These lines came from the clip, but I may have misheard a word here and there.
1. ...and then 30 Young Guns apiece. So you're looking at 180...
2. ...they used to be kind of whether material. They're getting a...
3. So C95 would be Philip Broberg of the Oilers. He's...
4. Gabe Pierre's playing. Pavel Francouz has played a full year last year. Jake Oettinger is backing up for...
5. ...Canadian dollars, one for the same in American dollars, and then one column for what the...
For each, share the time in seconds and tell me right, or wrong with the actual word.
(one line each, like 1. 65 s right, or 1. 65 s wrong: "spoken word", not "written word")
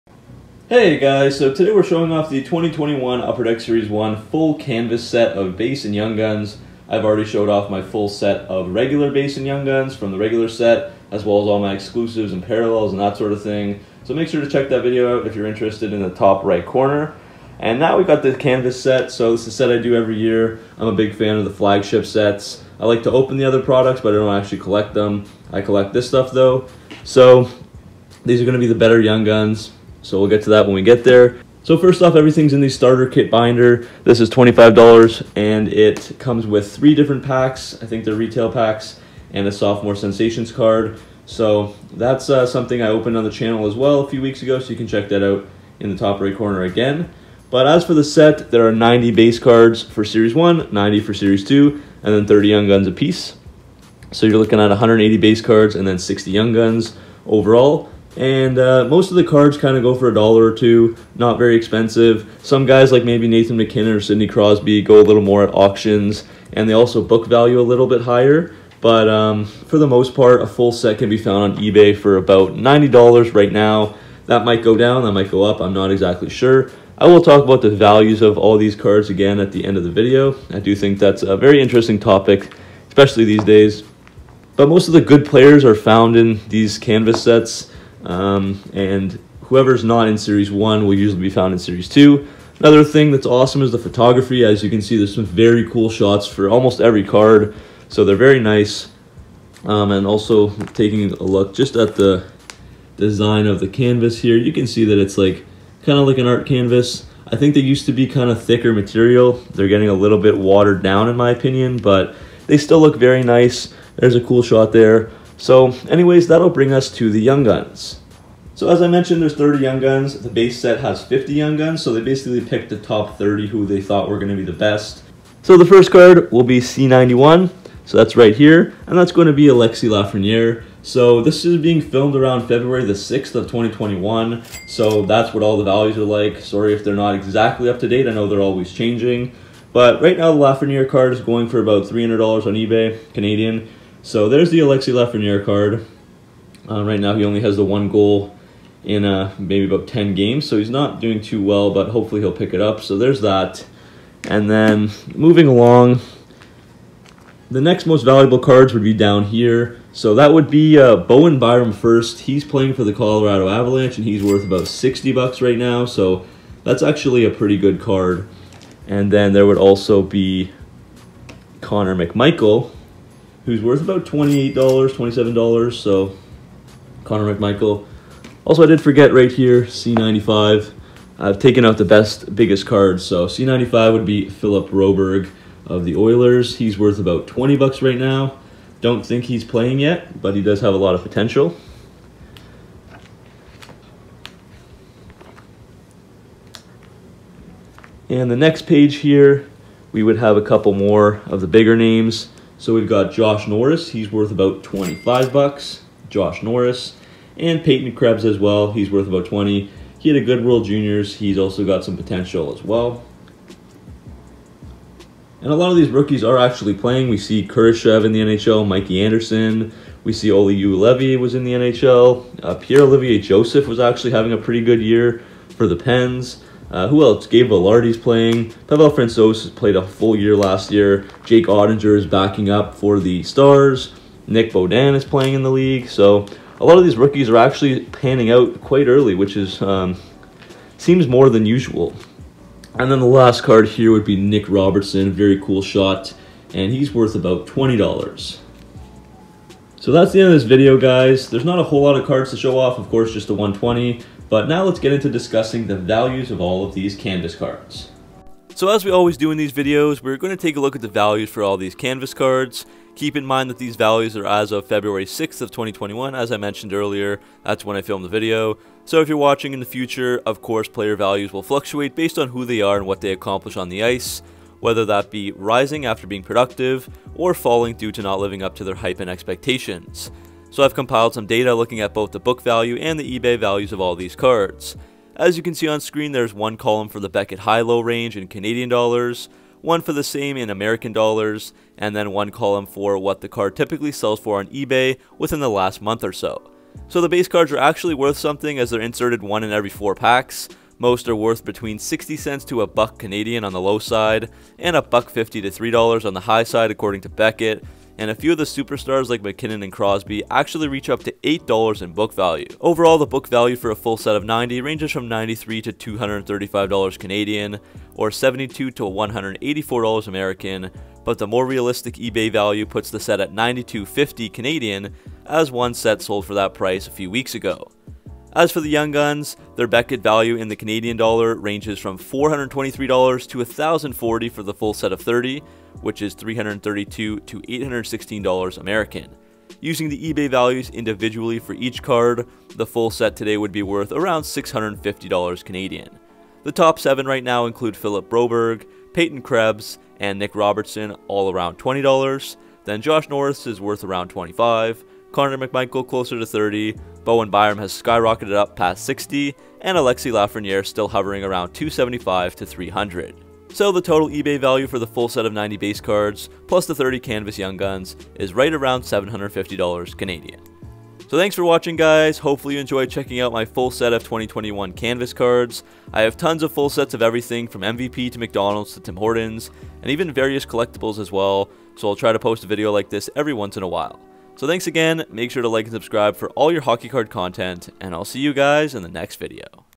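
1. 52 s right
2. 107 s wrong: "thicker", not "whether"
3. 183 s right
4. 227 s wrong: "Vilardi", not "Pierre"
5. 288 s right.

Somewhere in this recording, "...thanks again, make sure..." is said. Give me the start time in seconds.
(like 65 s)
384 s.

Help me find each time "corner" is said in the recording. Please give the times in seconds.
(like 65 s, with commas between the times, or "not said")
16 s, 46 s.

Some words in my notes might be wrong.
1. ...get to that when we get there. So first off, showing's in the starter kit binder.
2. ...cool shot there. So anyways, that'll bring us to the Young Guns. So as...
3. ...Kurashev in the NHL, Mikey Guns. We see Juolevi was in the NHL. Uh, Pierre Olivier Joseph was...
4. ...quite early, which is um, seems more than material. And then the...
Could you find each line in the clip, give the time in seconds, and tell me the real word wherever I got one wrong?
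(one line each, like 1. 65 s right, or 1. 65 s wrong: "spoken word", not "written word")
1. 30 s wrong: "everything", not "showing"
2. 114 s right
3. 217 s wrong: "Anderson", not "Guns"
4. 238 s wrong: "usual", not "material".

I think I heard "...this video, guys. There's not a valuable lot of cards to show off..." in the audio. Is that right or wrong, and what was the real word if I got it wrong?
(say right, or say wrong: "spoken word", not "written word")
wrong: "whole", not "valuable".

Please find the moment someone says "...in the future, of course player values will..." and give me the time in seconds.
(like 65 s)
269 s.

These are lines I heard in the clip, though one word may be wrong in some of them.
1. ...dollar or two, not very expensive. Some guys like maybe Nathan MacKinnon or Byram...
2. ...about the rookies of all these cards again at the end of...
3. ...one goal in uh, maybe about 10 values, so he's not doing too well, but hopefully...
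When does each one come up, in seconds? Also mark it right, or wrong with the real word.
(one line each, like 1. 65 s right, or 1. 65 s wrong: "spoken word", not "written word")
1. 60 s wrong: "Sidney", not "Byram"
2. 77 s wrong: "values", not "rookies"
3. 147 s wrong: "games", not "values".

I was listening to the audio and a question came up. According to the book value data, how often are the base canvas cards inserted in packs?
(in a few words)
one in every four packs.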